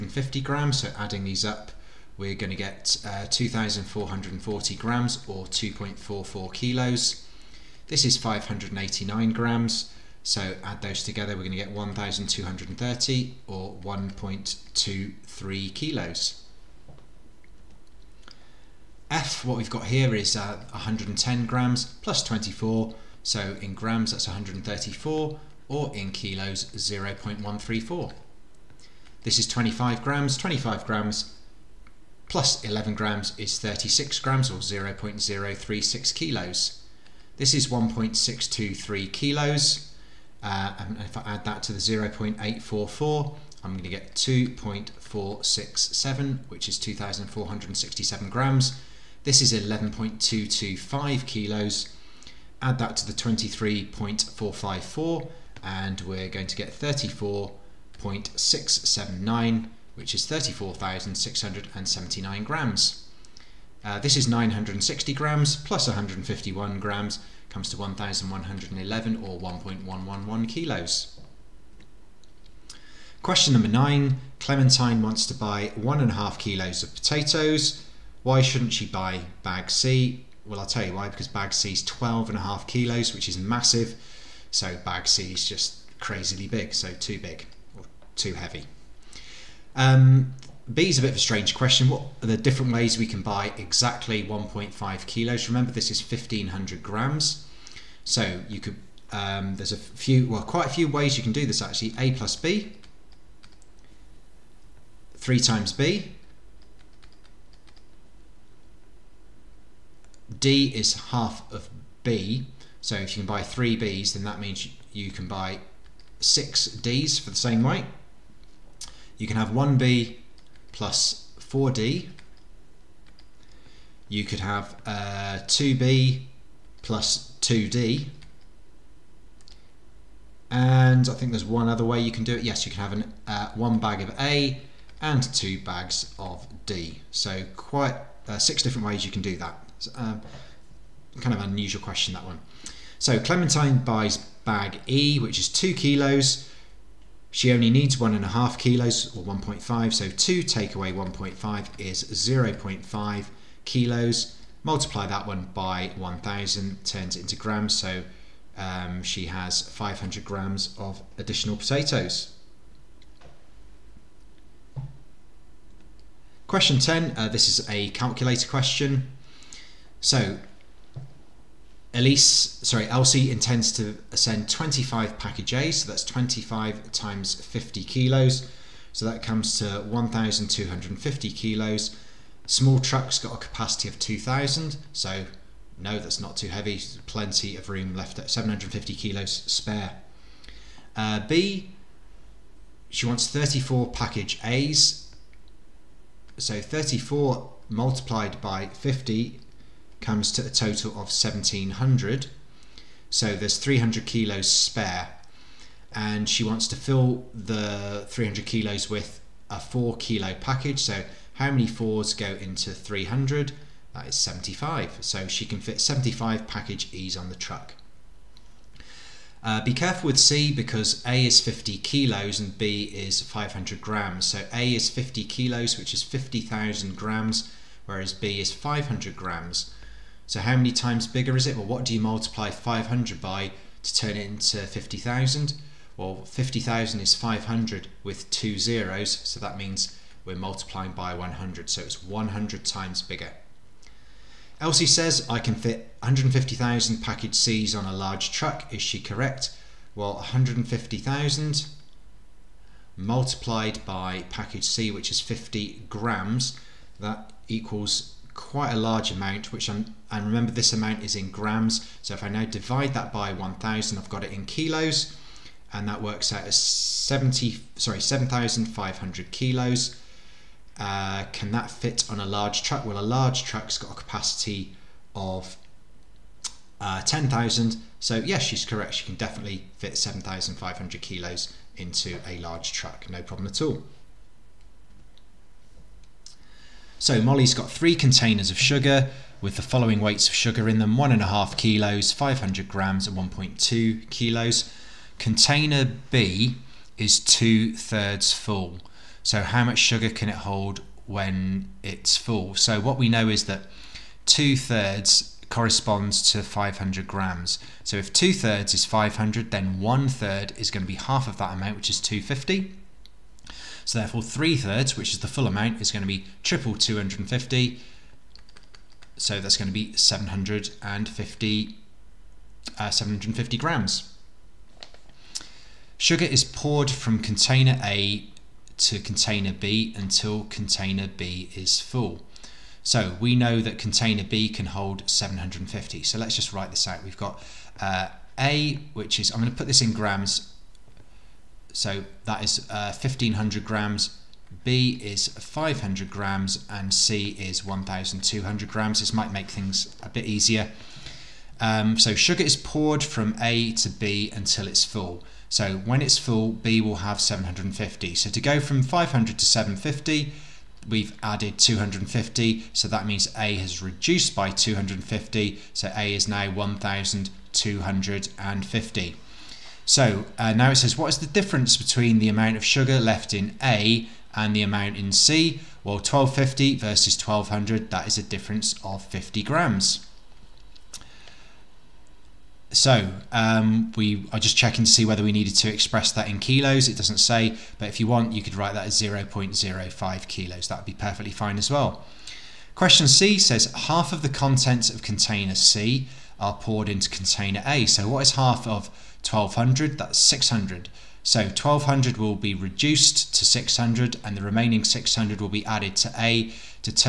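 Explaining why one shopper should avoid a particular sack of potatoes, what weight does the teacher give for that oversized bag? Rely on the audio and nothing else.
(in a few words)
12.5 kilos.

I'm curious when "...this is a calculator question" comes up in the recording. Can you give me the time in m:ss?
2:47.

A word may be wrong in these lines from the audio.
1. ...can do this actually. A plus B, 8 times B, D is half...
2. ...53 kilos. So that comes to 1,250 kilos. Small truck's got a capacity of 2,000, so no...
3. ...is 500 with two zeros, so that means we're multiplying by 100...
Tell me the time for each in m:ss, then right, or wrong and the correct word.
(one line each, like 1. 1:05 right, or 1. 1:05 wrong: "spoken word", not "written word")
1. 1:41 wrong: "3", not "8"
2. 2:57 wrong: "50", not "53"
3. 3:57 right.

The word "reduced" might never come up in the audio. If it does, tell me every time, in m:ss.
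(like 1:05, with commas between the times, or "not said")
6:03, 6:42.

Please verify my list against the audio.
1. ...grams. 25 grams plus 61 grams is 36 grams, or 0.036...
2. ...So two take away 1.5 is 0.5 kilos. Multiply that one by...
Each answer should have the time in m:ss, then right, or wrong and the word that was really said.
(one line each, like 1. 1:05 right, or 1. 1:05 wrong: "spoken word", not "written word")
1. 0:30 wrong: "11", not "61"
2. 2:29 right.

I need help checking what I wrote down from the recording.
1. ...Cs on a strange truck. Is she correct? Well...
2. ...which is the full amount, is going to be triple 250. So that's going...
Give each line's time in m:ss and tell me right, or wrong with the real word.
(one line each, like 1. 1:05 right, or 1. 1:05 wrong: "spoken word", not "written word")
1. 4:07 wrong: "large", not "strange"
2. 5:14 right.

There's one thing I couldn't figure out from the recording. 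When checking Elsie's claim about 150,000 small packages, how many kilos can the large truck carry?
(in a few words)
10,000.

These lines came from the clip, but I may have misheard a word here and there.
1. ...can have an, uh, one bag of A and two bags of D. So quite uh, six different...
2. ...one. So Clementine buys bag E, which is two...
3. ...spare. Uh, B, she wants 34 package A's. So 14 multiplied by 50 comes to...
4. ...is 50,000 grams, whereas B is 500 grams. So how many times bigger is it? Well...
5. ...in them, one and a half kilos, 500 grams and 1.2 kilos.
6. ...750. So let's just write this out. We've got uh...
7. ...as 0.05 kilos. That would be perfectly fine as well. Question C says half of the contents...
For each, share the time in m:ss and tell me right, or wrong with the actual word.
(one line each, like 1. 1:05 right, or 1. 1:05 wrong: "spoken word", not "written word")
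1. 2:12 right
2. 2:22 right
3. 3:09 wrong: "34", not "14"
4. 3:45 right
5. 4:50 right
6. 5:35 right
7. 6:28 right.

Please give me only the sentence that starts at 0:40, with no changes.
Uh, and if I add that to the 0.844, I'm going to get 2.467, which is 2,467 grams.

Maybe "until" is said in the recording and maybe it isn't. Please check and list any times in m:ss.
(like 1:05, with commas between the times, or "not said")
5:29, 5:54.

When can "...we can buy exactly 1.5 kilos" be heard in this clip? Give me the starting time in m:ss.
1:32.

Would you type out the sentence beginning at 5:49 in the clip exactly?
This might make things a bit easier.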